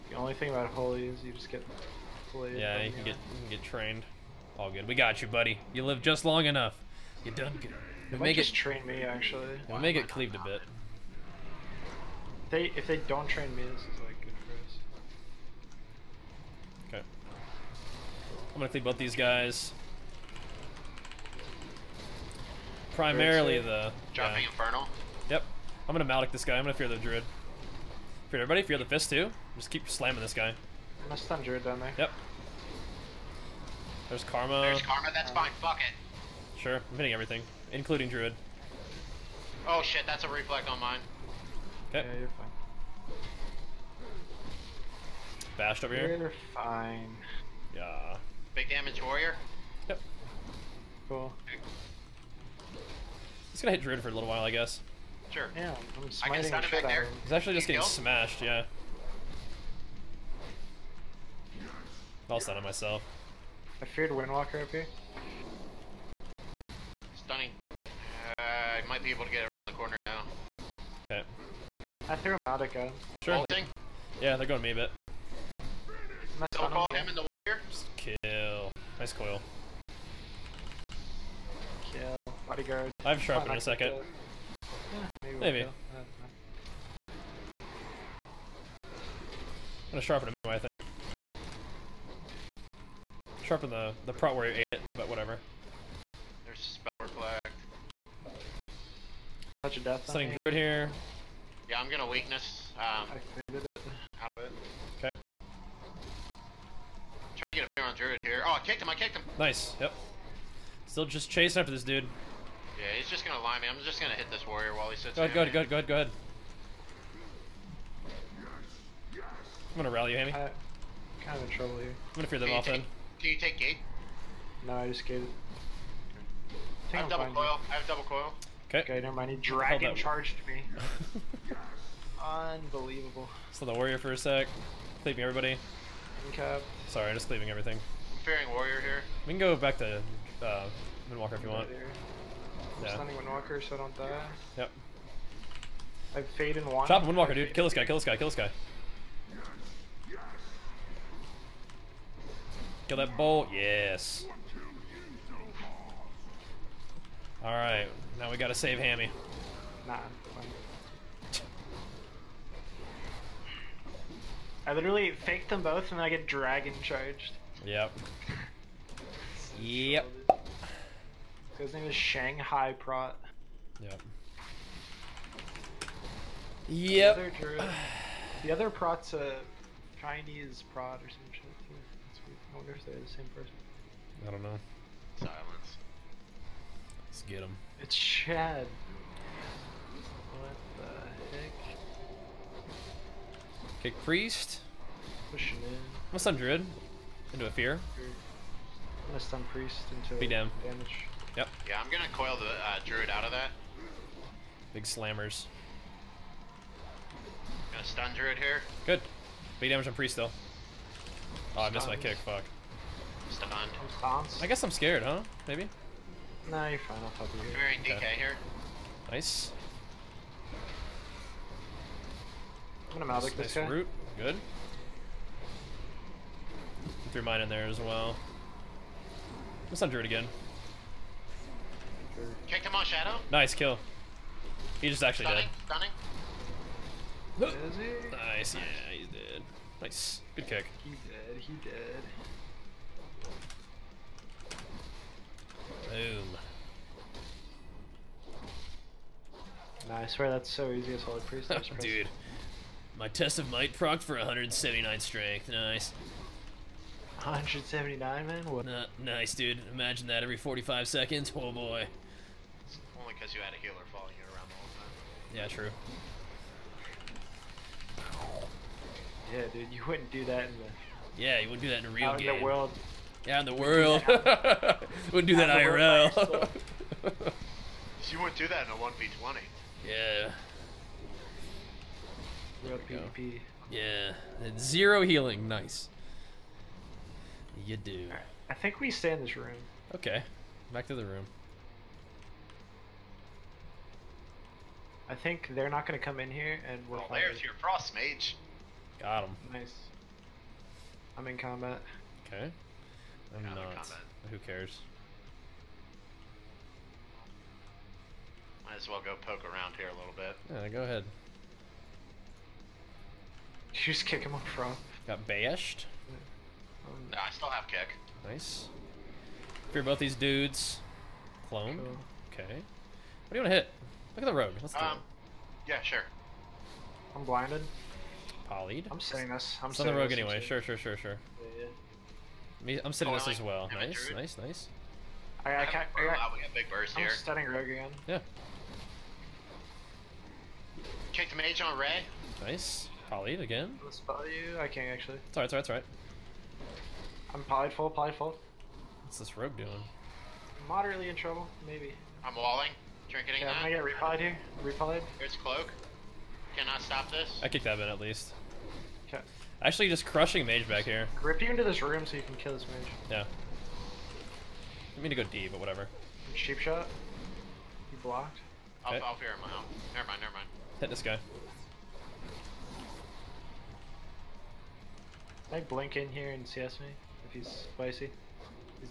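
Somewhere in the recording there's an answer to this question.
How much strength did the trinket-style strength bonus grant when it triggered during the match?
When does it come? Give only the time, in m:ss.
4:14.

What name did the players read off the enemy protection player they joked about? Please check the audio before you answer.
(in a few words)
Shanghai Prot.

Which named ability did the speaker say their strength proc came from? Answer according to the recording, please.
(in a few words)
Test of Might.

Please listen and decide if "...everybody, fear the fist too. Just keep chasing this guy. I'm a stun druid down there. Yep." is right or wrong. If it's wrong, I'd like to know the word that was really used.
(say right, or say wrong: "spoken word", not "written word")
wrong: "slamming", not "chasing".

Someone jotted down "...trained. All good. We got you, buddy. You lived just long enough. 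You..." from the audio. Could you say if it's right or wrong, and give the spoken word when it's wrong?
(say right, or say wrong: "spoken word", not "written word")
right.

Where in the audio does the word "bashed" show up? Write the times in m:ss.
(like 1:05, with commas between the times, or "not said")
0:45, 5:15.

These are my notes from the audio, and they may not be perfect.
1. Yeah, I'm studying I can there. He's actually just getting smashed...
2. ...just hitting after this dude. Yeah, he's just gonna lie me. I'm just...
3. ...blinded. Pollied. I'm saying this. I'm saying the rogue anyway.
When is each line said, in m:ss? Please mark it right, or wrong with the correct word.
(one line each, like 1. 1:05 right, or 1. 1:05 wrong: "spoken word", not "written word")
1. 0:55 wrong: "smiting", not "studying"
2. 1:51 wrong: "chasing", not "hitting"
3. 5:27 right.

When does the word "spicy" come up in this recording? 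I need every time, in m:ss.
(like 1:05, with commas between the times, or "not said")
6:17.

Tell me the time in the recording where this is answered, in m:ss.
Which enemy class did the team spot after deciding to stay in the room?
4:57.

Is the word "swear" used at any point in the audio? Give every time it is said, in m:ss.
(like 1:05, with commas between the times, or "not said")
4:10.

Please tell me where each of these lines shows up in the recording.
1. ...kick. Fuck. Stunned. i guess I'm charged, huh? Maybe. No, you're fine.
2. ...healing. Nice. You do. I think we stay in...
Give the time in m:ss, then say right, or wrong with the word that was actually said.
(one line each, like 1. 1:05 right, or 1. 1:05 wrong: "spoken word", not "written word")
1. 3:31 wrong: "scared", not "charged"
2. 4:45 right.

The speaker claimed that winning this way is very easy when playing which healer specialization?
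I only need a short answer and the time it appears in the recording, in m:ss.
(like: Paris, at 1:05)
Holy Priest, at 4:11.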